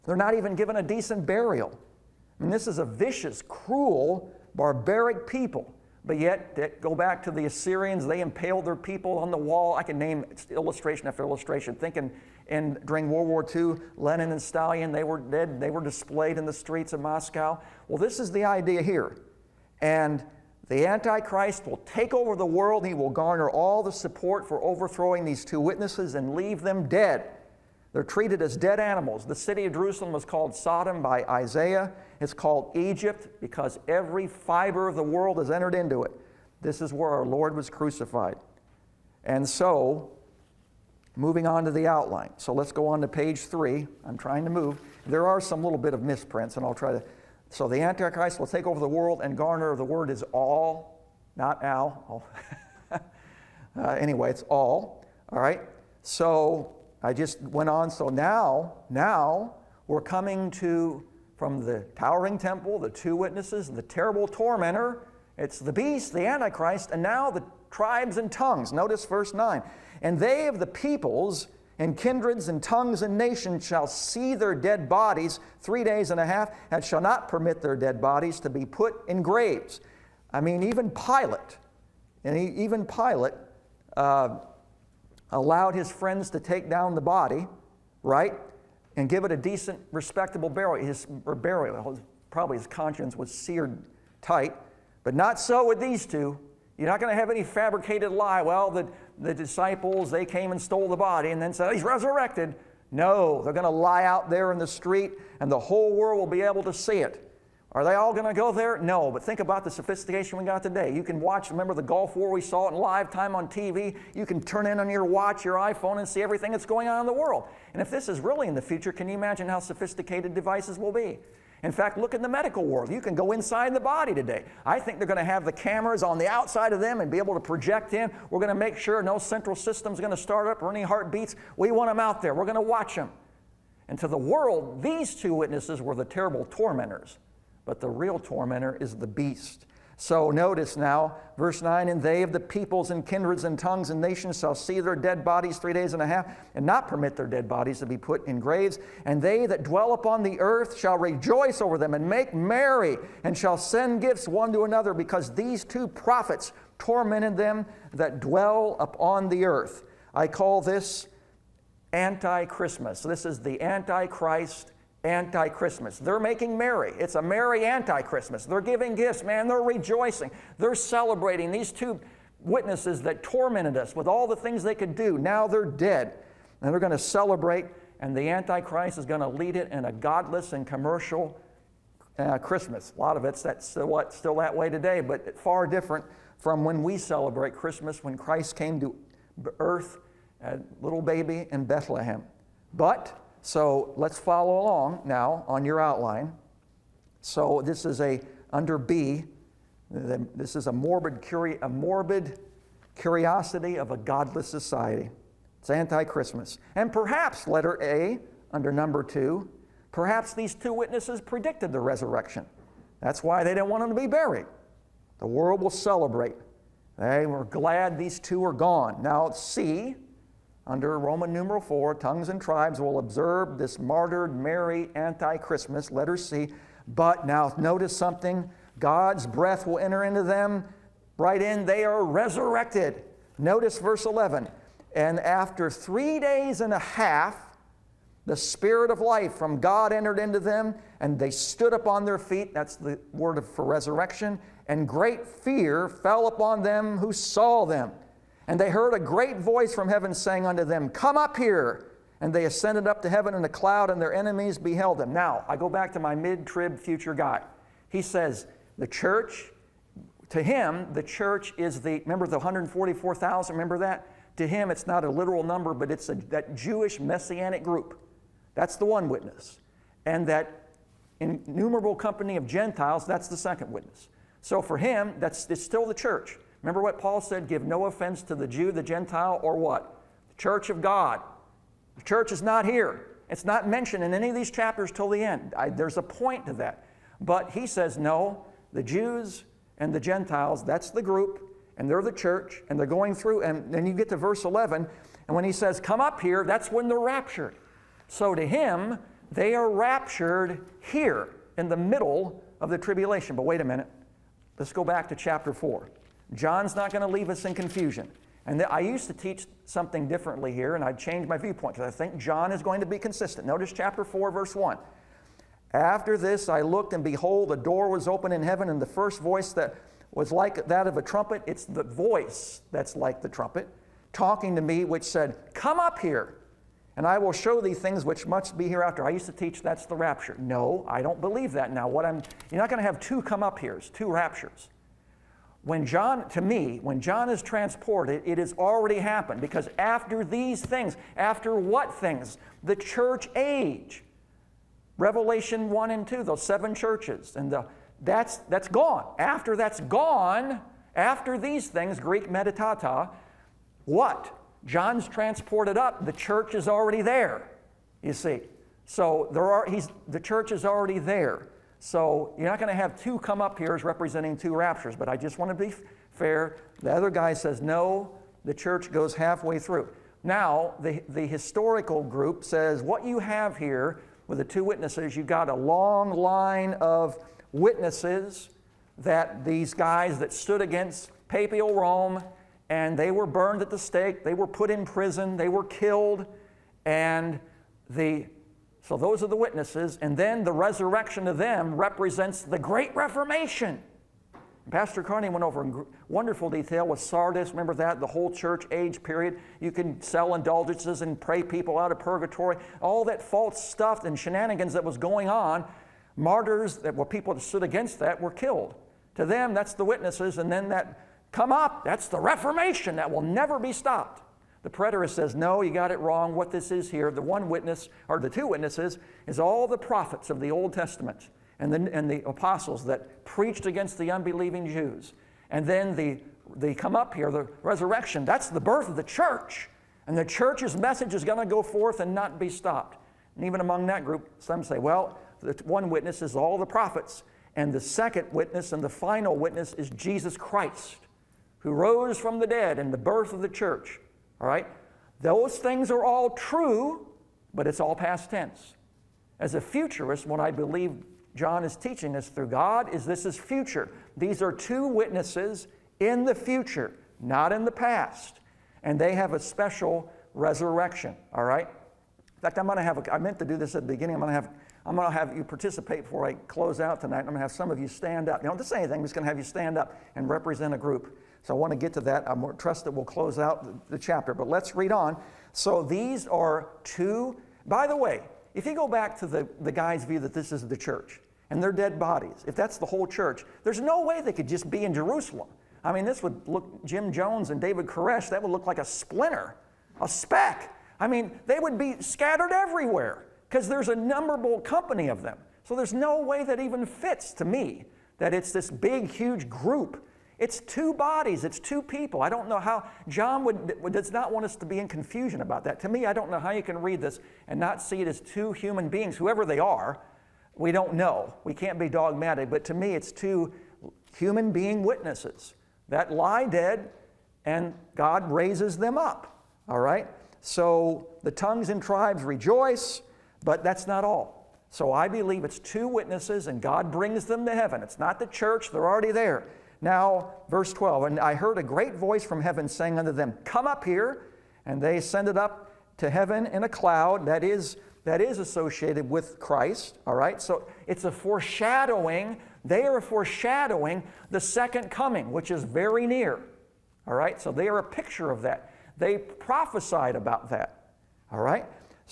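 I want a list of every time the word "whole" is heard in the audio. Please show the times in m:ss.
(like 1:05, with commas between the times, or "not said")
1:45, 6:38, 8:02.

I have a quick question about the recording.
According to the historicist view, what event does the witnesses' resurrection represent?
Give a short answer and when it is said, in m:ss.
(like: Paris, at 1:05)
The Great Reformation, at 6:32.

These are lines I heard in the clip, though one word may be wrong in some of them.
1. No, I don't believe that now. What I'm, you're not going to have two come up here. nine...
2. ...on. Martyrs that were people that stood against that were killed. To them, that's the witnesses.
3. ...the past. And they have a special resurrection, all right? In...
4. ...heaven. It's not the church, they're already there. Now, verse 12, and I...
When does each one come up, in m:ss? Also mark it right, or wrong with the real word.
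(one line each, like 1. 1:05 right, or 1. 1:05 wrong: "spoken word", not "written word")
1. 5:30 wrong: "two", not "nine"
2. 6:45 right
3. 7:37 right
4. 8:47 right.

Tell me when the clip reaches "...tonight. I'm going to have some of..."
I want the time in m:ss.
7:47.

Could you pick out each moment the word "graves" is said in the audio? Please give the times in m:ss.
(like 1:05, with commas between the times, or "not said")
1:19, 2:28.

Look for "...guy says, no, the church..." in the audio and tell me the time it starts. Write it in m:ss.
6:07.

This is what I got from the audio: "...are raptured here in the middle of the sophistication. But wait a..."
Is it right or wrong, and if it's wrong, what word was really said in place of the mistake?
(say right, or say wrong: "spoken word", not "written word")
wrong: "tribulation", not "sophistication".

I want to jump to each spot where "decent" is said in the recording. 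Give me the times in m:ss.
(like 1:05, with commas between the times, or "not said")
0:00, 1:29.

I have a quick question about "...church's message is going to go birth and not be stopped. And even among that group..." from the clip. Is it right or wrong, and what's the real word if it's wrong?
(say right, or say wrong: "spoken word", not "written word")
wrong: "forth", not "birth".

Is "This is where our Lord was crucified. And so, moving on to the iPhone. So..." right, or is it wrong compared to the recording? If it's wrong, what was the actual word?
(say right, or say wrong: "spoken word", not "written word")
wrong: "outline", not "iPhone".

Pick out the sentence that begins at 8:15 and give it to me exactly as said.
So there's no way that even fits to me that it's this big, huge group it's two bodies, it's two people.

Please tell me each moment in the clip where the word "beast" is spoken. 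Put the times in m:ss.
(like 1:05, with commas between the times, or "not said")
1:05, 2:19.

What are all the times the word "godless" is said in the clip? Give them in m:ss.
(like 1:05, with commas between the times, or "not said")
2:59, 3:23.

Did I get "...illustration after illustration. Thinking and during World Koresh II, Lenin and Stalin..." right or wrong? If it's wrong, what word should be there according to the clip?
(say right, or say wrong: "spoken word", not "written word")
wrong: "War", not "Koresh".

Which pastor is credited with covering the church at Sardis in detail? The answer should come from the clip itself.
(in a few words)
Pastor Carney.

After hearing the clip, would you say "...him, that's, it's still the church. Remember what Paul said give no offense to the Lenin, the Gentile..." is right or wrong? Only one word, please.
wrong.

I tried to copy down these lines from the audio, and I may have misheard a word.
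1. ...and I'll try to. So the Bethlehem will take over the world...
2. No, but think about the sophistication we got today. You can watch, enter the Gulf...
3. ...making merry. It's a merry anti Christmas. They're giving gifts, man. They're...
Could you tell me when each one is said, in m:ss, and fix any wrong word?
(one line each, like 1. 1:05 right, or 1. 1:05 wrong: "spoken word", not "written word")
1. 0:46 wrong: "Antichrist", not "Bethlehem"
2. 1:48 wrong: "remember", not "enter"
3. 2:46 right.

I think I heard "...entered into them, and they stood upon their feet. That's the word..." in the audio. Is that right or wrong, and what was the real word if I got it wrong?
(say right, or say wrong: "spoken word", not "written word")
right.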